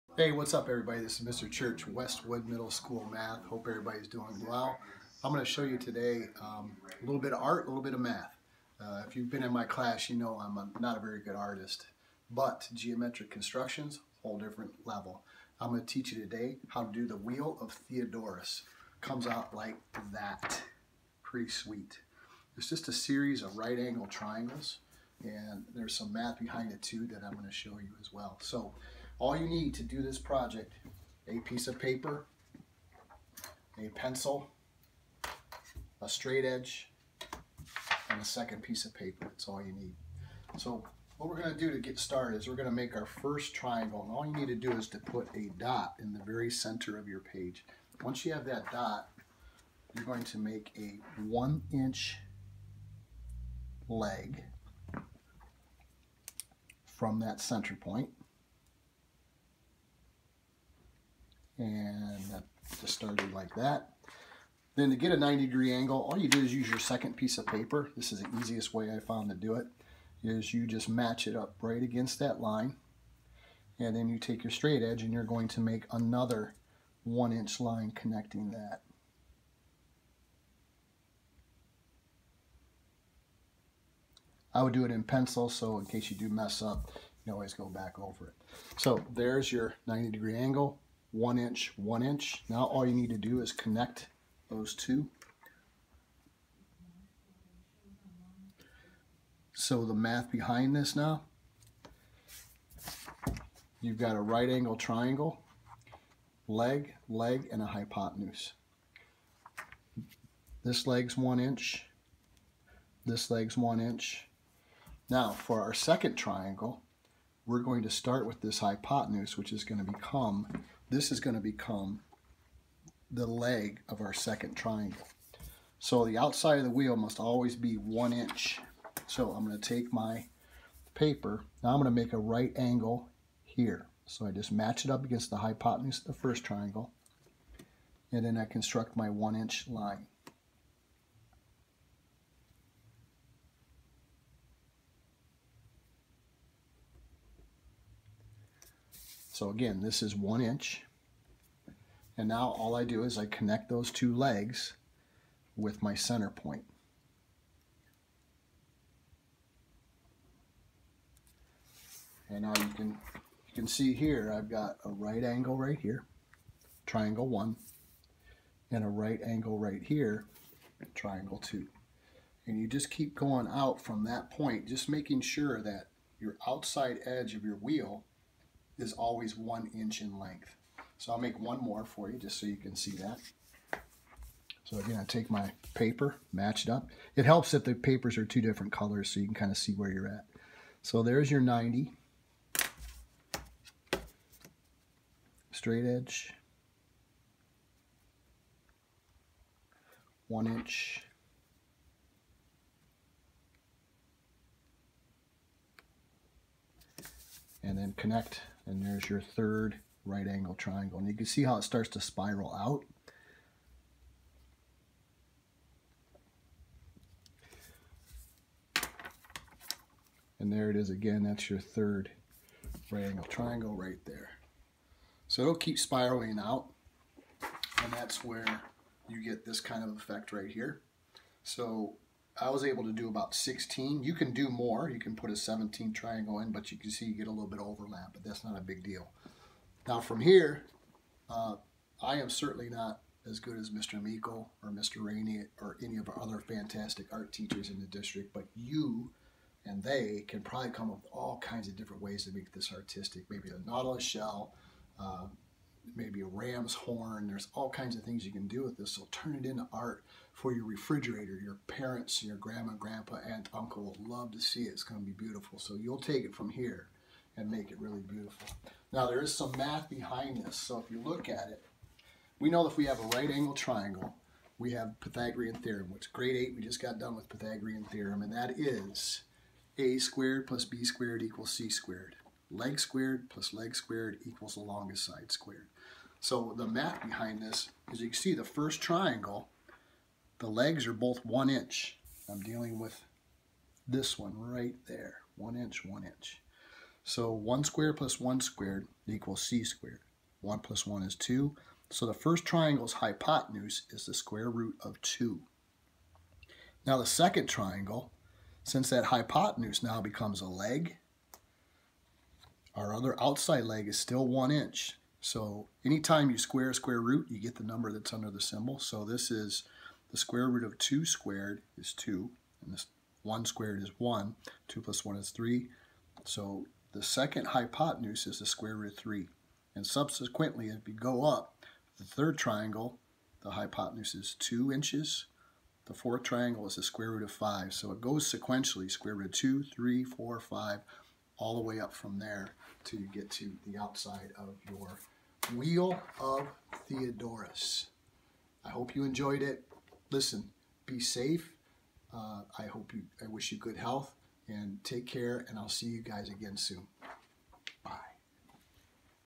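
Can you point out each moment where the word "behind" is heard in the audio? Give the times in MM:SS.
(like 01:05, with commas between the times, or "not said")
00:26, 01:40, 04:29, 04:47.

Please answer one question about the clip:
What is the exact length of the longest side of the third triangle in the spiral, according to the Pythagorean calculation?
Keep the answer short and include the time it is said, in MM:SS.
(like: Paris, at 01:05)
2 inches, at 05:34.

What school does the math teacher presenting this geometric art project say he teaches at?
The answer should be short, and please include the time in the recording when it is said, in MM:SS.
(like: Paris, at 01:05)
Westwood Middle School, at 00:01.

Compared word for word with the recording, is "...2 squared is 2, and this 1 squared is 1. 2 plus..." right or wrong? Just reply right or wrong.
right.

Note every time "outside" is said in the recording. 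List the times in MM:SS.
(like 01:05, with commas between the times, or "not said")
02:06, 02:56, 05:13, 05:43.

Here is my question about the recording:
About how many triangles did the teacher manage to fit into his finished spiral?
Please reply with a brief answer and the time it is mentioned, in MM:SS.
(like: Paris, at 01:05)
16, at 03:53.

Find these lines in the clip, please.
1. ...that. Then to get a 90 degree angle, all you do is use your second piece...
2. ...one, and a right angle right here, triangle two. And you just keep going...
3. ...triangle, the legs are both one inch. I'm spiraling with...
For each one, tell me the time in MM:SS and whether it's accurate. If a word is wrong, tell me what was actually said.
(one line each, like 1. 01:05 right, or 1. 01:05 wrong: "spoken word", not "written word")
1. 01:03 right
2. 02:47 right
3. 04:48 wrong: "dealing", not "spiraling".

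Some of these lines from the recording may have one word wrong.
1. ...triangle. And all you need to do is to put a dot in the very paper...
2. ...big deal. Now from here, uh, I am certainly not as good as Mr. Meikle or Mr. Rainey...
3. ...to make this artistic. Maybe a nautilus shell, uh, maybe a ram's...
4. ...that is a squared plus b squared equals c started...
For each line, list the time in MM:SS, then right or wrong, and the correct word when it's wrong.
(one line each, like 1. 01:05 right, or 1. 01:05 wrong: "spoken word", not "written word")
1. 00:43 wrong: "center", not "paper"
2. 03:58 right
3. 04:12 right
4. 04:38 wrong: "squared", not "started".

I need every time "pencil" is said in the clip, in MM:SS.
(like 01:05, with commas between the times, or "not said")
00:33, 01:25.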